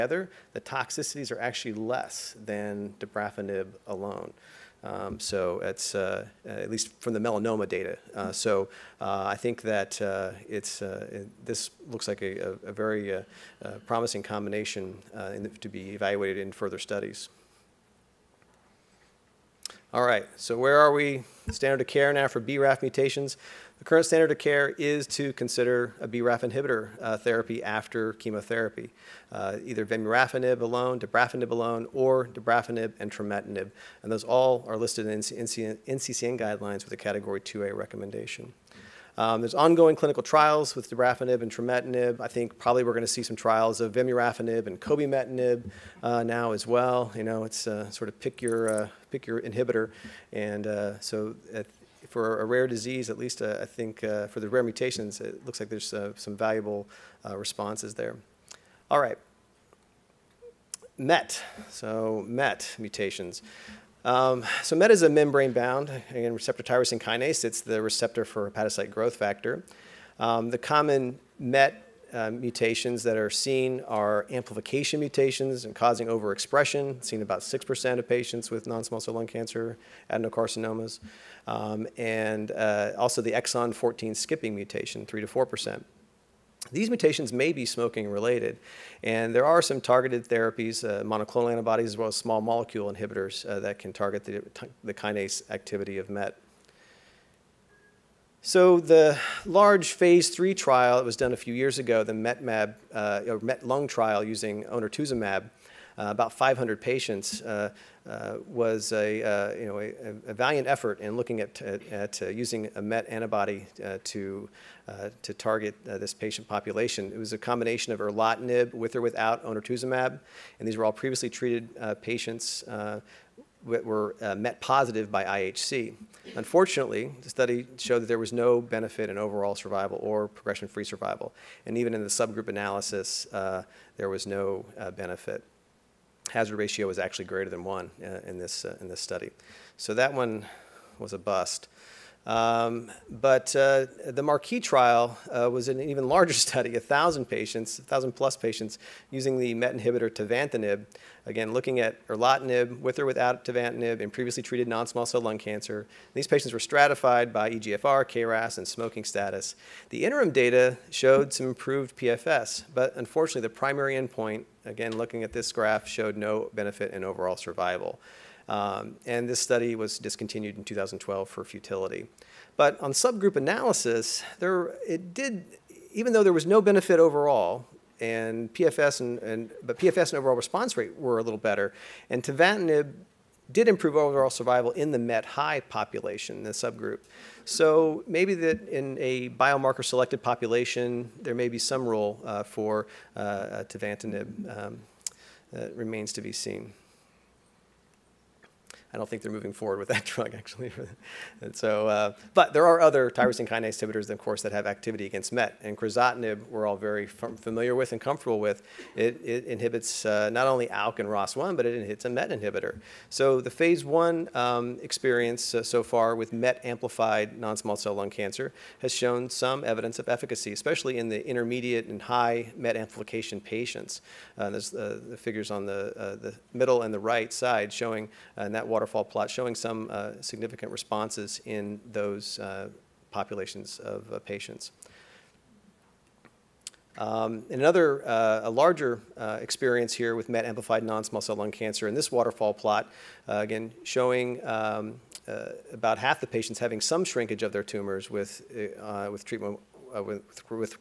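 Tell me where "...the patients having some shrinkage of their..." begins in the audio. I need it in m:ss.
4:06.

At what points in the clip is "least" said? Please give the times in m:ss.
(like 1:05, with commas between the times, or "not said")
0:06, 0:53.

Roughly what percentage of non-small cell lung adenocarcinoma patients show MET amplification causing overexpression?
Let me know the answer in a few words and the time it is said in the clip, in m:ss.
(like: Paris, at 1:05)
6%, at 1:17.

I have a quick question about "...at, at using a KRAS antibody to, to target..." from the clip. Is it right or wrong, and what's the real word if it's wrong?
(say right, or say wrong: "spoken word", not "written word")
wrong: "MET", not "KRAS".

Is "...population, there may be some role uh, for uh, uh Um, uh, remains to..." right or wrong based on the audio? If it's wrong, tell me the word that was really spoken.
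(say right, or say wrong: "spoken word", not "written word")
right.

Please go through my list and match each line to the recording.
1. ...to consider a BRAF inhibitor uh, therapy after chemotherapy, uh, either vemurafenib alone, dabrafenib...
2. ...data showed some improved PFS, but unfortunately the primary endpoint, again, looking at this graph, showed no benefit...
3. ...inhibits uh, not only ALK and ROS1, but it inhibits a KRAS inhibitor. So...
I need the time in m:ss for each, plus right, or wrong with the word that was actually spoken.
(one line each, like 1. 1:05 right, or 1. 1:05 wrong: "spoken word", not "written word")
1. 0:25 right
2. 2:40 right
3. 3:29 wrong: "MET", not "KRAS".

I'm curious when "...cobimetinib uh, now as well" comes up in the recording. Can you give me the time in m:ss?
0:44.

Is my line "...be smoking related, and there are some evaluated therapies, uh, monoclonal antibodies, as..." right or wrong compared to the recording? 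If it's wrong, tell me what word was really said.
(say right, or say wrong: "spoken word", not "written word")
wrong: "targeted", not "evaluated".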